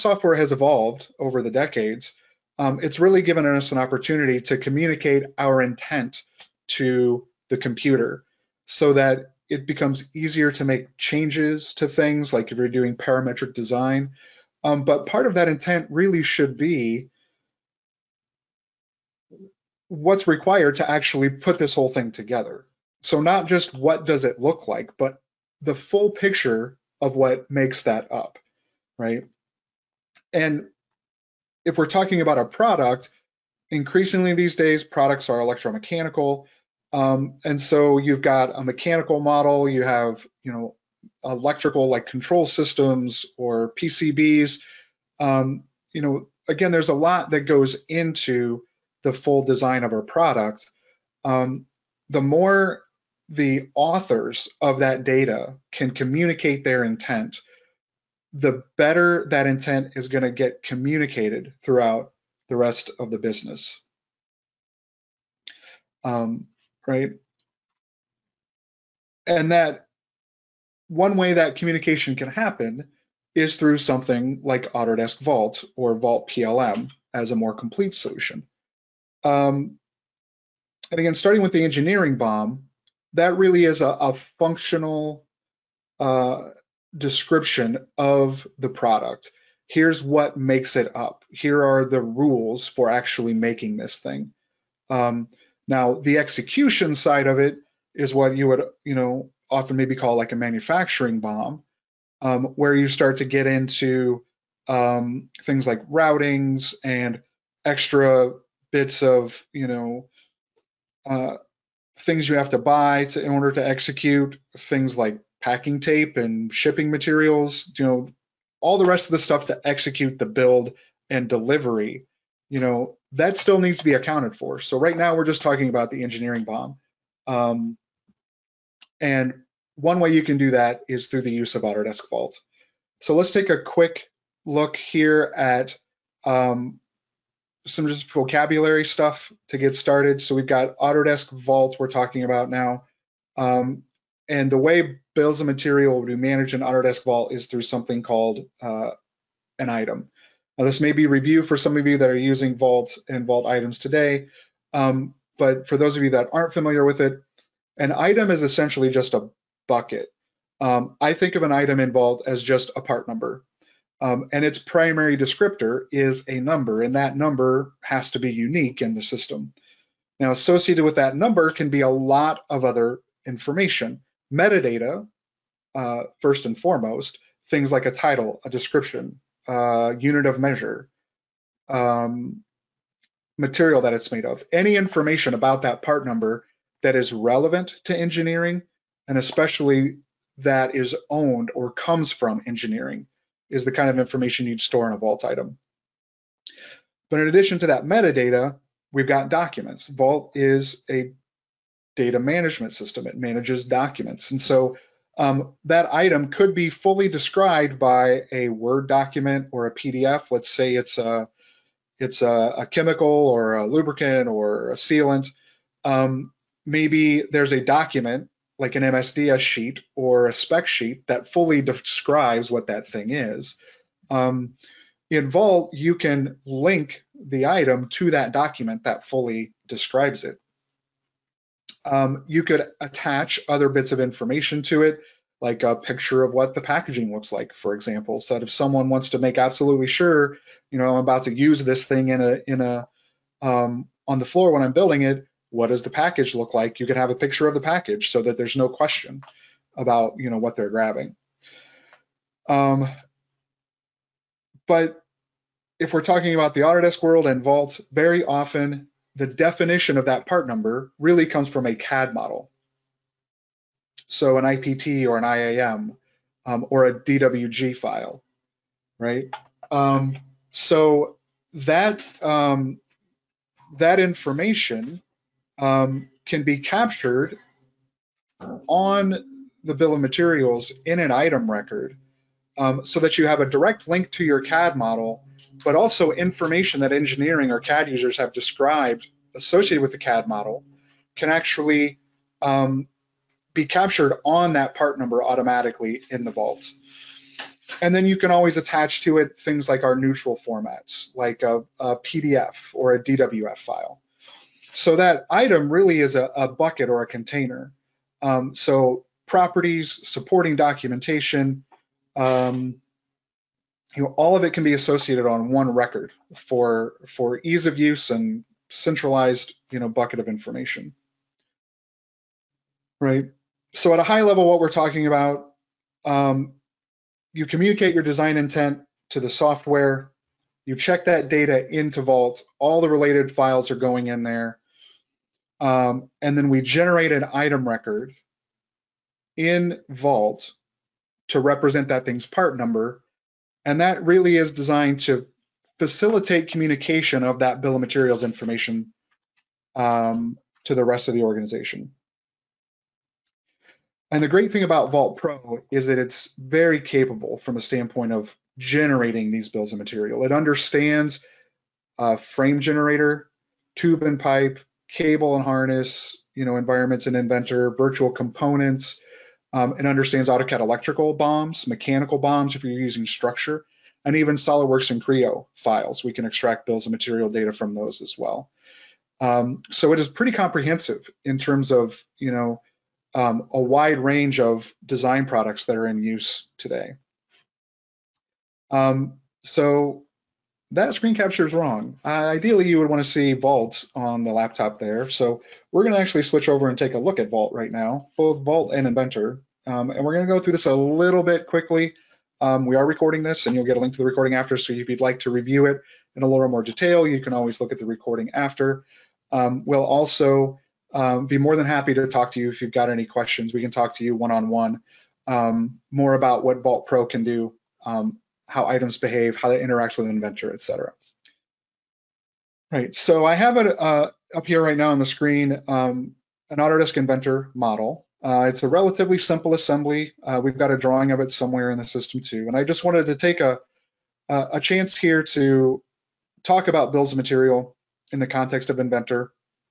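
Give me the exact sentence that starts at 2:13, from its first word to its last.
So let's take a quick look here at um, some just vocabulary stuff to get started.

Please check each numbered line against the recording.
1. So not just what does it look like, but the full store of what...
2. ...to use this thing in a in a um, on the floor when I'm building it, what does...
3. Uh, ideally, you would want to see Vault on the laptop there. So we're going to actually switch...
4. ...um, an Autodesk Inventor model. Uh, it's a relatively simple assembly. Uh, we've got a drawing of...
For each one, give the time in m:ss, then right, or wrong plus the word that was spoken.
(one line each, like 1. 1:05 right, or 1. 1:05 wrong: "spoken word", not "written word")
1. 0:23 wrong: "picture", not "store"
2. 4:01 right
3. 6:32 right
4. 7:05 right.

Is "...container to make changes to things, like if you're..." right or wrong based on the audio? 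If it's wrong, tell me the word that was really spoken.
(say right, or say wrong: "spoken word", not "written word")
wrong: "easier", not "container".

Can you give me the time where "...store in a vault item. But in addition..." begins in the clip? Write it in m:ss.
3:14.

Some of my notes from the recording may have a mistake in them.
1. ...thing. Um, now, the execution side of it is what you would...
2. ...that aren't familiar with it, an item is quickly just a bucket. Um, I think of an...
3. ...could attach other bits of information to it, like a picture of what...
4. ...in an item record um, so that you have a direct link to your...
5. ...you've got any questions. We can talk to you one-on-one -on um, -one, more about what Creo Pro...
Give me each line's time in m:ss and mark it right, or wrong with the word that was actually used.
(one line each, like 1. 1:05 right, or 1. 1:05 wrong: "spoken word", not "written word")
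1. 1:33 right
2. 2:36 wrong: "essentially", not "quickly"
3. 3:52 right
4. 4:40 right
5. 6:52 wrong: "Vault", not "Creo".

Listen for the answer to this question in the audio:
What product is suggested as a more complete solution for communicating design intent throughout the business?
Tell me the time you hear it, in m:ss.
1:15.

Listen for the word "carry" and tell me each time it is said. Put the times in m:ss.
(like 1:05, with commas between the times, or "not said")
not said.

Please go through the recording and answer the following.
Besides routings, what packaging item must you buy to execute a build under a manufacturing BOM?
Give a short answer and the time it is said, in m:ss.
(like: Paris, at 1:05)
packing tape, at 1:55.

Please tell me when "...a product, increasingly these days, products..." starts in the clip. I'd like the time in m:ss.
0:32.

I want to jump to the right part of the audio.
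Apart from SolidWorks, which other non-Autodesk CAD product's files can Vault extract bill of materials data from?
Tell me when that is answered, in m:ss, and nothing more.
6:15.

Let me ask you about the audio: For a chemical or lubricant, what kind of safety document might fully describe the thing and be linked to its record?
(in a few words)
MSDS sheet.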